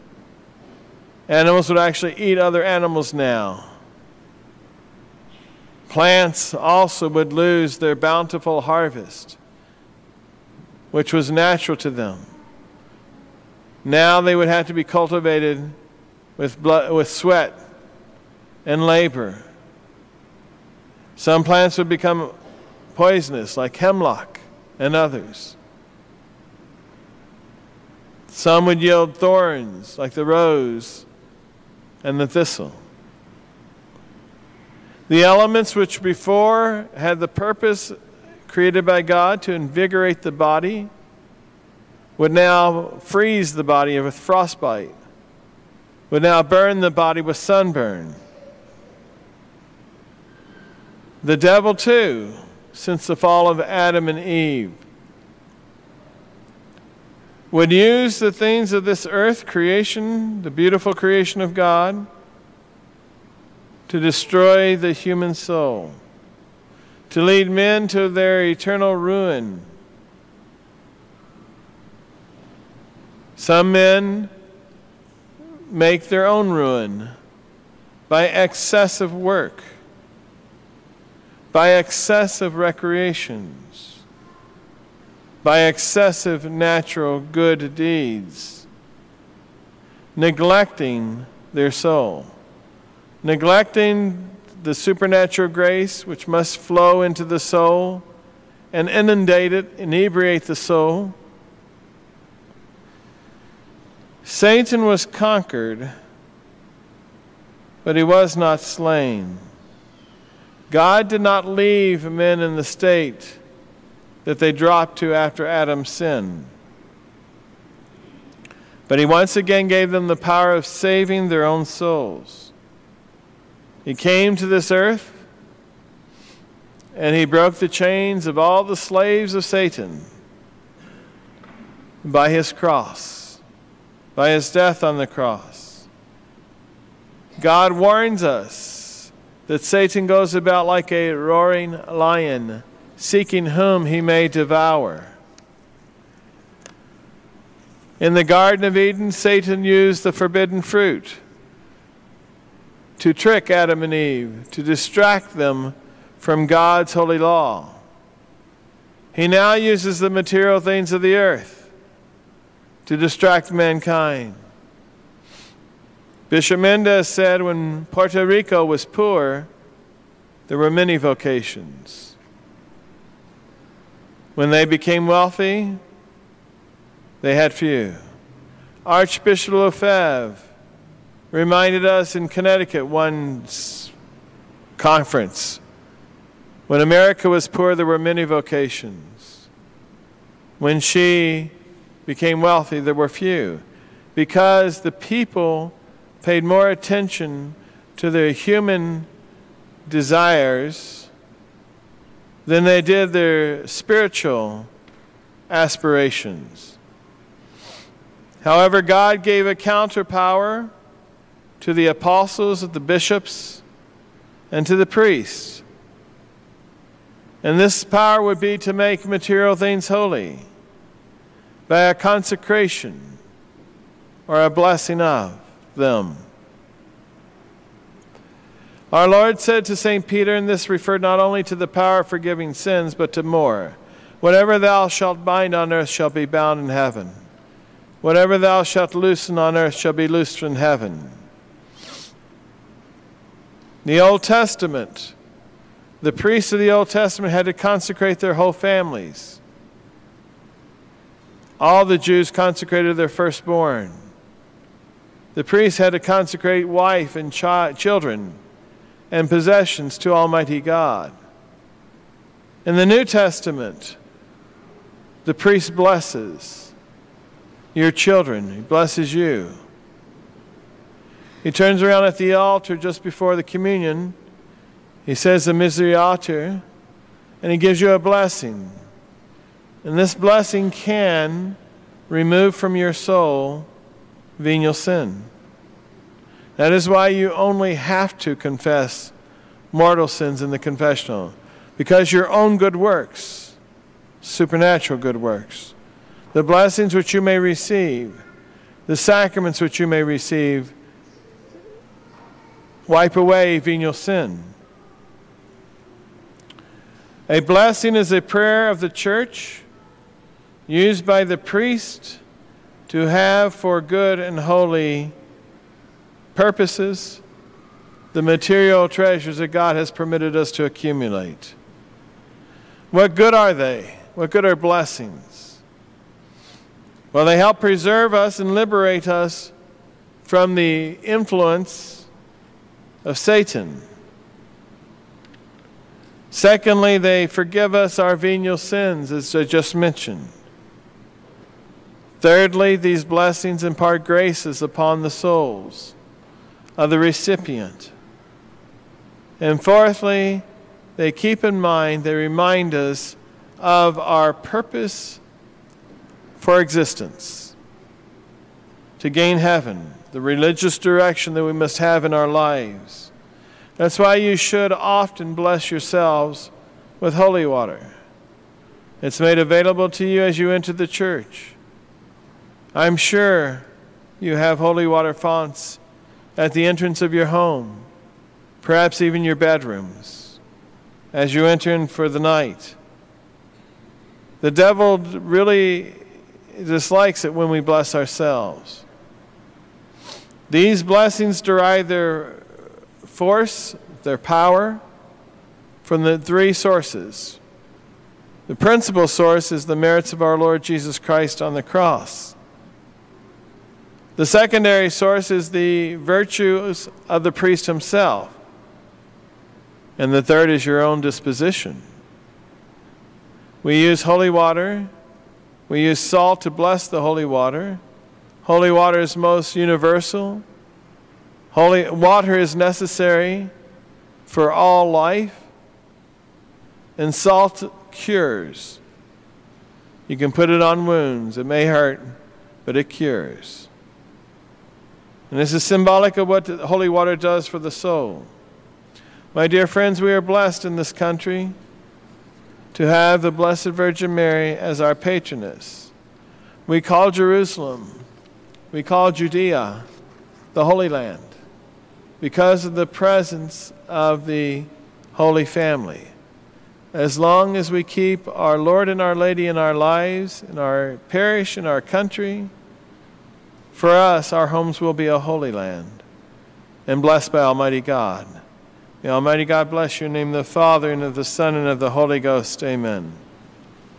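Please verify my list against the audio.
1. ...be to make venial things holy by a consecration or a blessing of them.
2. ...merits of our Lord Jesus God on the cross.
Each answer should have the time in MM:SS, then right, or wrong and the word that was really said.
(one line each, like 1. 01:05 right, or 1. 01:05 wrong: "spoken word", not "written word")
1. 03:38 wrong: "material", not "venial"
2. 06:39 wrong: "Christ", not "God".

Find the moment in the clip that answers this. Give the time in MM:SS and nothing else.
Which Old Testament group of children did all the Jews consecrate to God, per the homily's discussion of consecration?
04:13.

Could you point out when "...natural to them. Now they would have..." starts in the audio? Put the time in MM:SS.
00:11.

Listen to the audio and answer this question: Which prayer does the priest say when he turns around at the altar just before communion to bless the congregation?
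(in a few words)
The Misereatur.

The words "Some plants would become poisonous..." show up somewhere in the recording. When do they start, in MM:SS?
00:21.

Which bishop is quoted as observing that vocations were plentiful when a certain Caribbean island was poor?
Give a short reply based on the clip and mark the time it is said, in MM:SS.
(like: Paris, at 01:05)
Bishop Mendez, at 02:46.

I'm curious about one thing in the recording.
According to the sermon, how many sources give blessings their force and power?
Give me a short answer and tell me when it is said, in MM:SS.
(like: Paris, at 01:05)
3, at 06:36.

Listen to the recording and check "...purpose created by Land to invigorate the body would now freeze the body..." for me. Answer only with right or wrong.
wrong.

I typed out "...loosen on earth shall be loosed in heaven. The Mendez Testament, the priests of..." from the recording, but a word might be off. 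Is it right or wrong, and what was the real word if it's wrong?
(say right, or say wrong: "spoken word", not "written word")
wrong: "Old", not "Mendez".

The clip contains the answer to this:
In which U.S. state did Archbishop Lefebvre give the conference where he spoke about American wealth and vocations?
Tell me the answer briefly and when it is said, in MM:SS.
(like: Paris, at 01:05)
Connecticut, at 03:02.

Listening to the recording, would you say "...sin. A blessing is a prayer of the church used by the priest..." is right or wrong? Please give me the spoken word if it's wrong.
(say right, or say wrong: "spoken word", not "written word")
right.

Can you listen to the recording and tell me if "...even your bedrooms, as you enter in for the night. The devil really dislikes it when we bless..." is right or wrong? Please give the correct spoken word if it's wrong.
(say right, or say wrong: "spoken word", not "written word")
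right.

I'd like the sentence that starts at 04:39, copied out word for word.
And this blessing can remove from your soul venial sin.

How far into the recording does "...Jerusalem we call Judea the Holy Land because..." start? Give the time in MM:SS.
07:27.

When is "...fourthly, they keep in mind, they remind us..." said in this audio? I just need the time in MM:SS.
05:49.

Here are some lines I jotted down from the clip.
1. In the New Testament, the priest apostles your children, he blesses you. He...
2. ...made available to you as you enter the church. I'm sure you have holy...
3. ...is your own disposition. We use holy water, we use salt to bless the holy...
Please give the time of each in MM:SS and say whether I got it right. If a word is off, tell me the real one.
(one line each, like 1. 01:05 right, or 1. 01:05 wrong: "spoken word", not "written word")
1. 04:22 wrong: "blesses", not "apostles"
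2. 06:09 right
3. 06:50 right.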